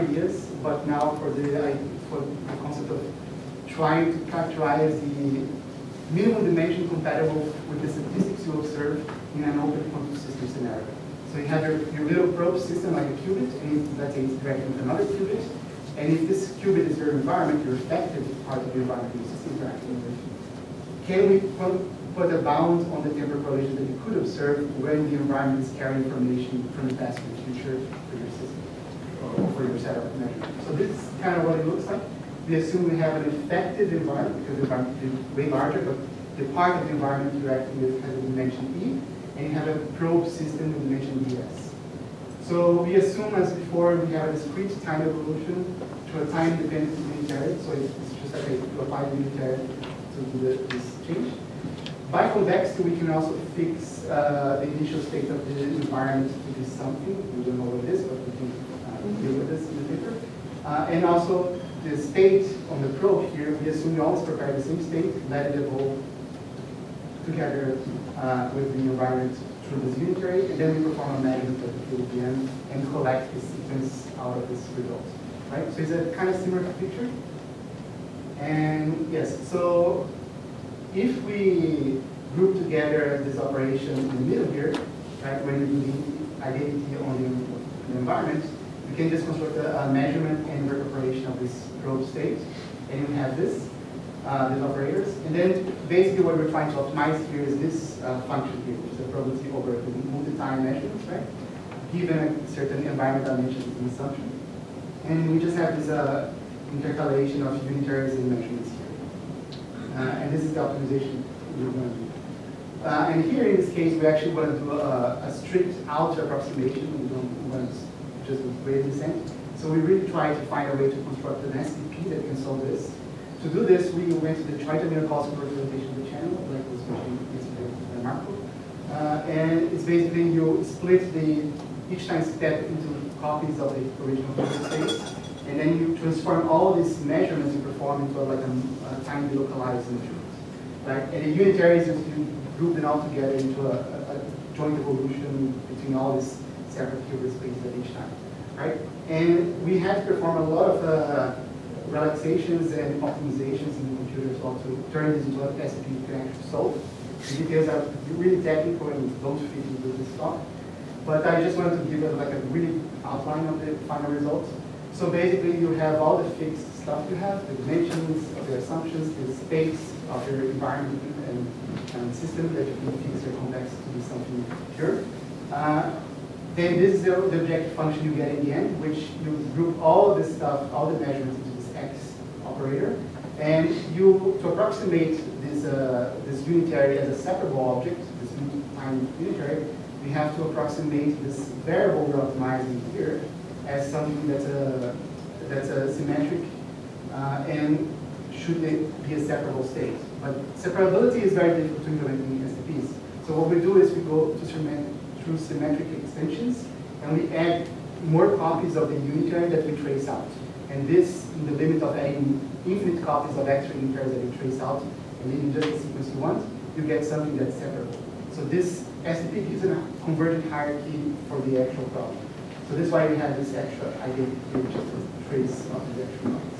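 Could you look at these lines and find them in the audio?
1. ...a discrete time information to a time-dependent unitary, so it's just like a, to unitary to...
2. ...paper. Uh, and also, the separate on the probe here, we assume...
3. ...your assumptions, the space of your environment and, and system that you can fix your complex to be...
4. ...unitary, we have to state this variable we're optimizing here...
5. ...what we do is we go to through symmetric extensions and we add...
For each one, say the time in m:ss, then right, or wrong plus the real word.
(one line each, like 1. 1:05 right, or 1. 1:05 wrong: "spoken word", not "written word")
1. 0:44 wrong: "evolution", not "information"
2. 0:59 wrong: "state", not "separate"
3. 2:48 right
4. 3:09 wrong: "approximate", not "state"
5. 3:23 right.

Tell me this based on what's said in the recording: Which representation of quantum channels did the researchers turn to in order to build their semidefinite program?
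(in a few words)
Choi-Jamiolkowski representation.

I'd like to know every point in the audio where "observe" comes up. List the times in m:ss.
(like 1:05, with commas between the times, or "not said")
0:08, 0:24.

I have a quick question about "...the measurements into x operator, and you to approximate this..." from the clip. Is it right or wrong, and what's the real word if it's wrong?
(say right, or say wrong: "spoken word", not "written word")
right.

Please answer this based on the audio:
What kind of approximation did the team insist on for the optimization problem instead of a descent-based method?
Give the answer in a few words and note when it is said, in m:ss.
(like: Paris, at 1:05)
strict outer approximation, at 1:55.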